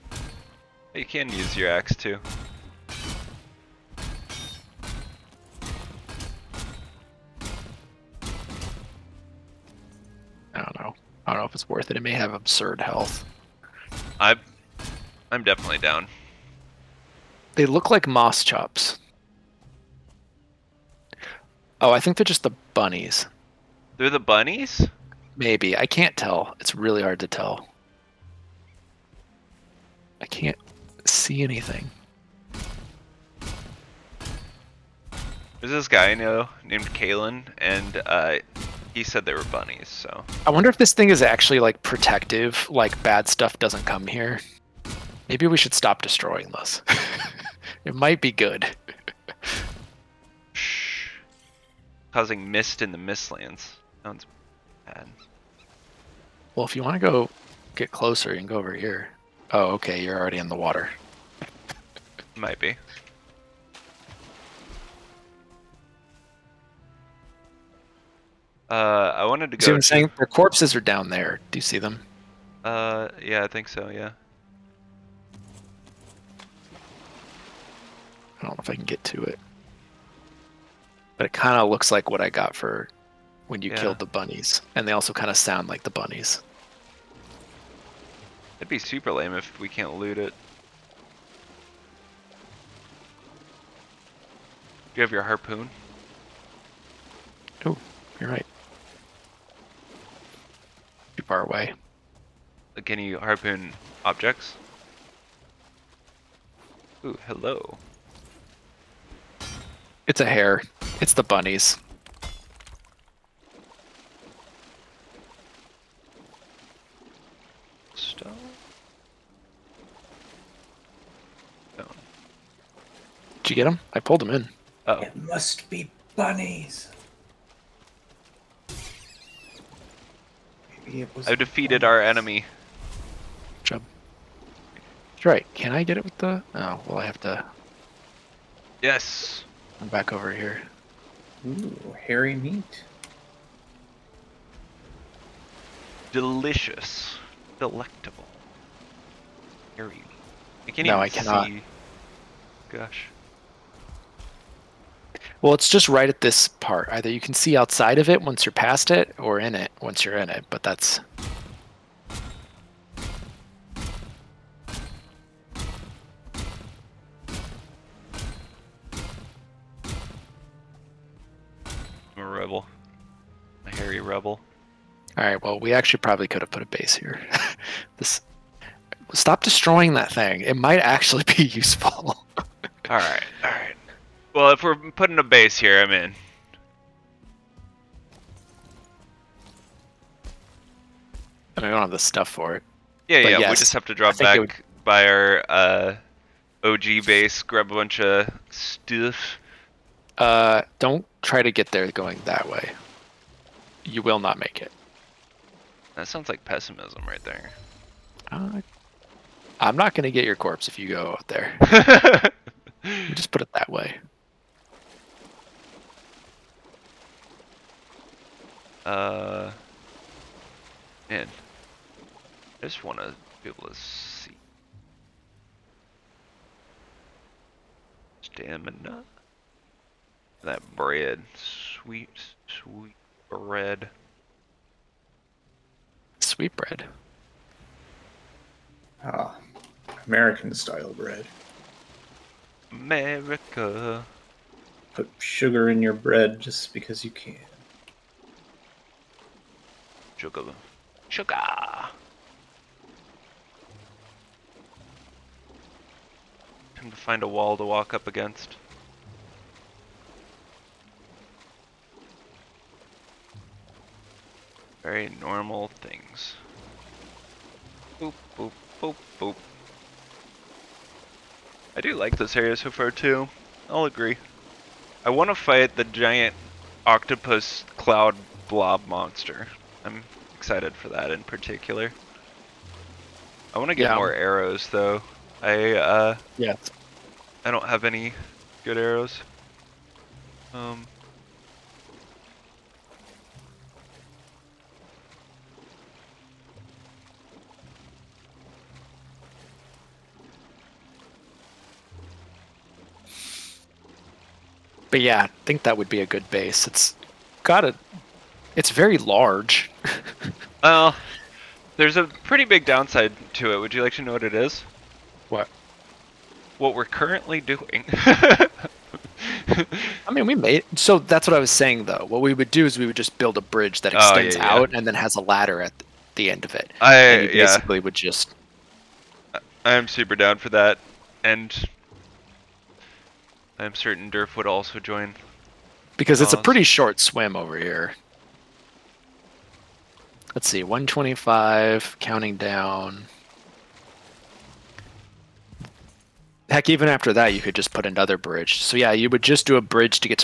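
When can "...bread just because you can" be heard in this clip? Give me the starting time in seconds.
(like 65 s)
245 s.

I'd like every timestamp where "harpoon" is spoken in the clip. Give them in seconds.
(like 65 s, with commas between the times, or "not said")
95 s, 103 s.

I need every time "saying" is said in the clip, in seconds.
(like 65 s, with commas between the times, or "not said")
69 s, 321 s.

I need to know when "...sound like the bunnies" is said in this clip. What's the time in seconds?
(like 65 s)
85 s.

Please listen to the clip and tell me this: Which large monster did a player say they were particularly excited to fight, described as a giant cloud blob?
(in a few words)
octopus.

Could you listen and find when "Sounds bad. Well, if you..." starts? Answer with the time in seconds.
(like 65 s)
54 s.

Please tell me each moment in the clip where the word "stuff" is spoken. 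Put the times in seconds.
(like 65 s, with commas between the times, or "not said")
43 s, 191 s, 198 s.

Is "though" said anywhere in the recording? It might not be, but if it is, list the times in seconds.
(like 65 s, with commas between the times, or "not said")
284 s, 321 s.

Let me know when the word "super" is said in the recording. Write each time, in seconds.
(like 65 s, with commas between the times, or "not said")
88 s, 329 s.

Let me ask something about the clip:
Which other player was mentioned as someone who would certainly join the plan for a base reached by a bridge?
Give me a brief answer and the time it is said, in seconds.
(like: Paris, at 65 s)
Durf, at 334 s.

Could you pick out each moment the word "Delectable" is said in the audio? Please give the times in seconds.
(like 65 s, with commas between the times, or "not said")
147 s.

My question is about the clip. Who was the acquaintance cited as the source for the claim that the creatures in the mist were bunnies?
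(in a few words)
Kalen.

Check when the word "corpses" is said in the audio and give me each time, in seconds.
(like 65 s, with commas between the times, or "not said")
70 s, 210 s.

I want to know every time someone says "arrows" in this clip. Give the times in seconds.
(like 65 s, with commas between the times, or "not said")
284 s, 288 s.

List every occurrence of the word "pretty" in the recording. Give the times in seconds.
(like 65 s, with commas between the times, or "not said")
312 s, 336 s.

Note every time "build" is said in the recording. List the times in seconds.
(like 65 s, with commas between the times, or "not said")
323 s.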